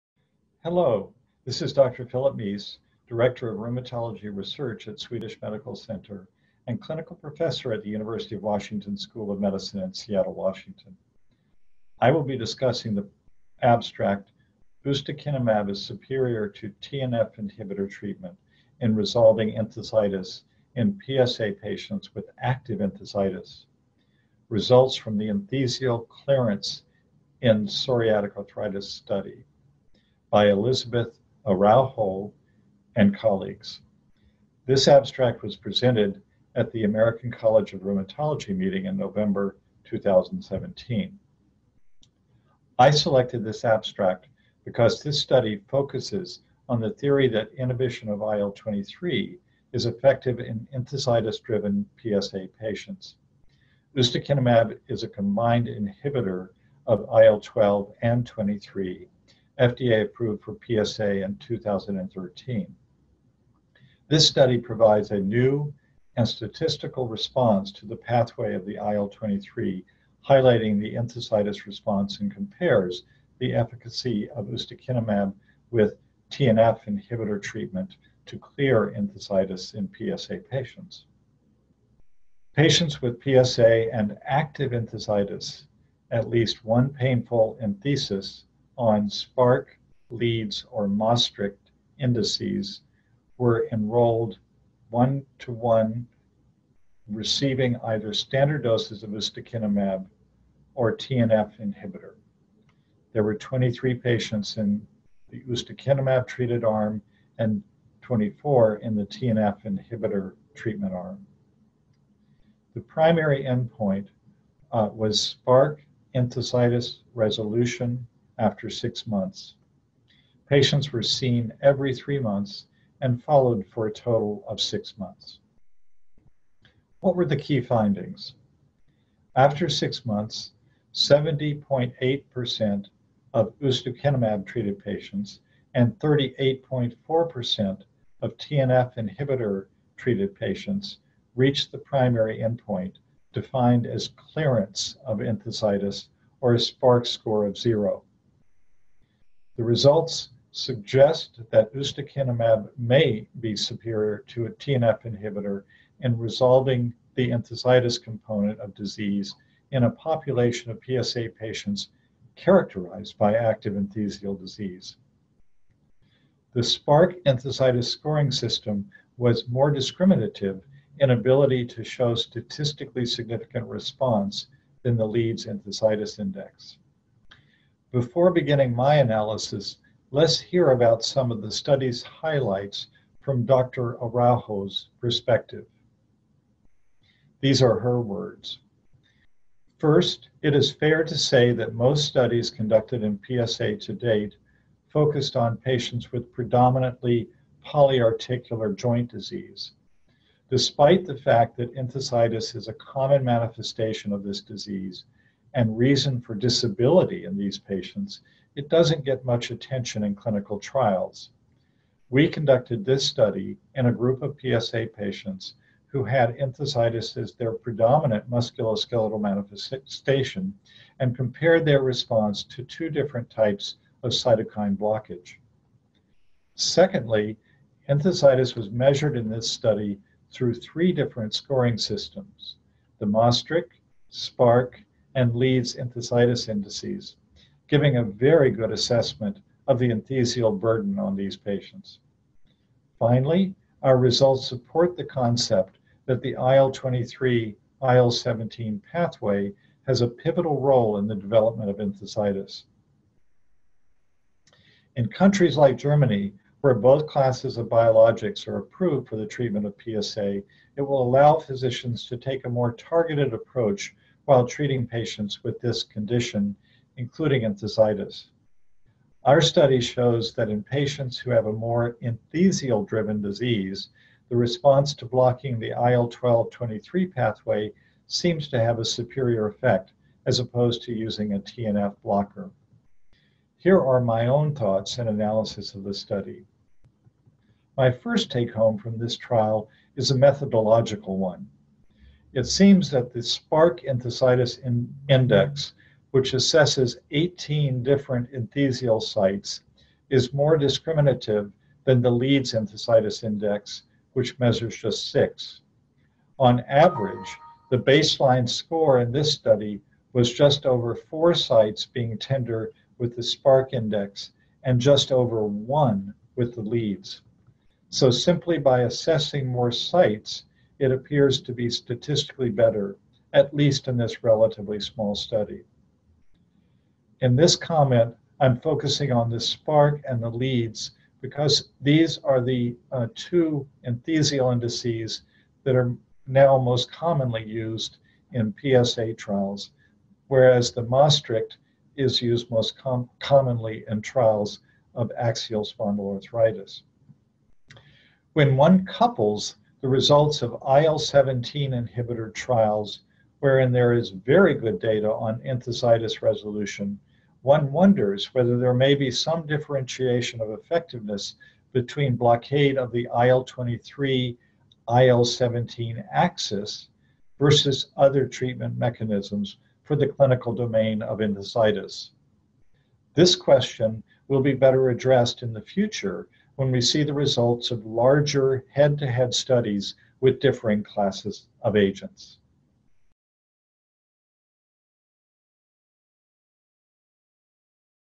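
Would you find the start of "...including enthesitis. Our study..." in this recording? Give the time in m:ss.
4:26.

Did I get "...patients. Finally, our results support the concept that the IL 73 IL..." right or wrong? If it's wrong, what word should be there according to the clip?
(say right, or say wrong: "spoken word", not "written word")
wrong: "23", not "73".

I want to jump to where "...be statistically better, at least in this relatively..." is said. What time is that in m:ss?
5:21.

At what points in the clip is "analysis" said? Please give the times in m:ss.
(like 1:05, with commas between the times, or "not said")
2:58, 4:45.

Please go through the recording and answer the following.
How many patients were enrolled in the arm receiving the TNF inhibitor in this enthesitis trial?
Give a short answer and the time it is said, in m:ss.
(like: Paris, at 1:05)
24, at 1:48.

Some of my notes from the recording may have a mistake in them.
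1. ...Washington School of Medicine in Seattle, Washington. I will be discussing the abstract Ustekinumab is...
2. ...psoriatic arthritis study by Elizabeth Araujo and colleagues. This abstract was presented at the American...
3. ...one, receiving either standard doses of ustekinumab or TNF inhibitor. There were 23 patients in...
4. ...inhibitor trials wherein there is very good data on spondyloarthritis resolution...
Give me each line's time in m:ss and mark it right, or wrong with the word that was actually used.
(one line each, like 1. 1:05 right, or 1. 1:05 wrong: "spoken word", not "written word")
1. 0:08 right
2. 0:27 right
3. 1:35 right
4. 5:51 wrong: "enthesitis", not "spondyloarthritis".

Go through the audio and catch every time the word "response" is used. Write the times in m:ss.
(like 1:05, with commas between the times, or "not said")
1:07, 1:11, 2:53, 3:41, 4:34.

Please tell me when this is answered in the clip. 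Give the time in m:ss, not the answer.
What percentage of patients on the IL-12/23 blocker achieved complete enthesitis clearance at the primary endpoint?
2:10.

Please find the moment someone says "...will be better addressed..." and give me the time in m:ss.
6:14.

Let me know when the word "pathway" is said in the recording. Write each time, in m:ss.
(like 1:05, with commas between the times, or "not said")
1:07, 4:08, 4:37.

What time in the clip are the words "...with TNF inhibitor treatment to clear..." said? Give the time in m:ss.
1:15.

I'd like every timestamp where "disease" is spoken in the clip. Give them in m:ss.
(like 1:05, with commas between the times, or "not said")
2:38, 2:44, 3:19, 3:24, 4:33.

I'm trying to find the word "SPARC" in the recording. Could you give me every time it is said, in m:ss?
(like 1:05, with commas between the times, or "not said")
1:29, 1:55, 2:26, 2:46, 3:54, 4:53, 5:13, 5:29.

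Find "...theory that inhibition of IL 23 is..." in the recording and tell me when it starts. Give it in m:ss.
0:46.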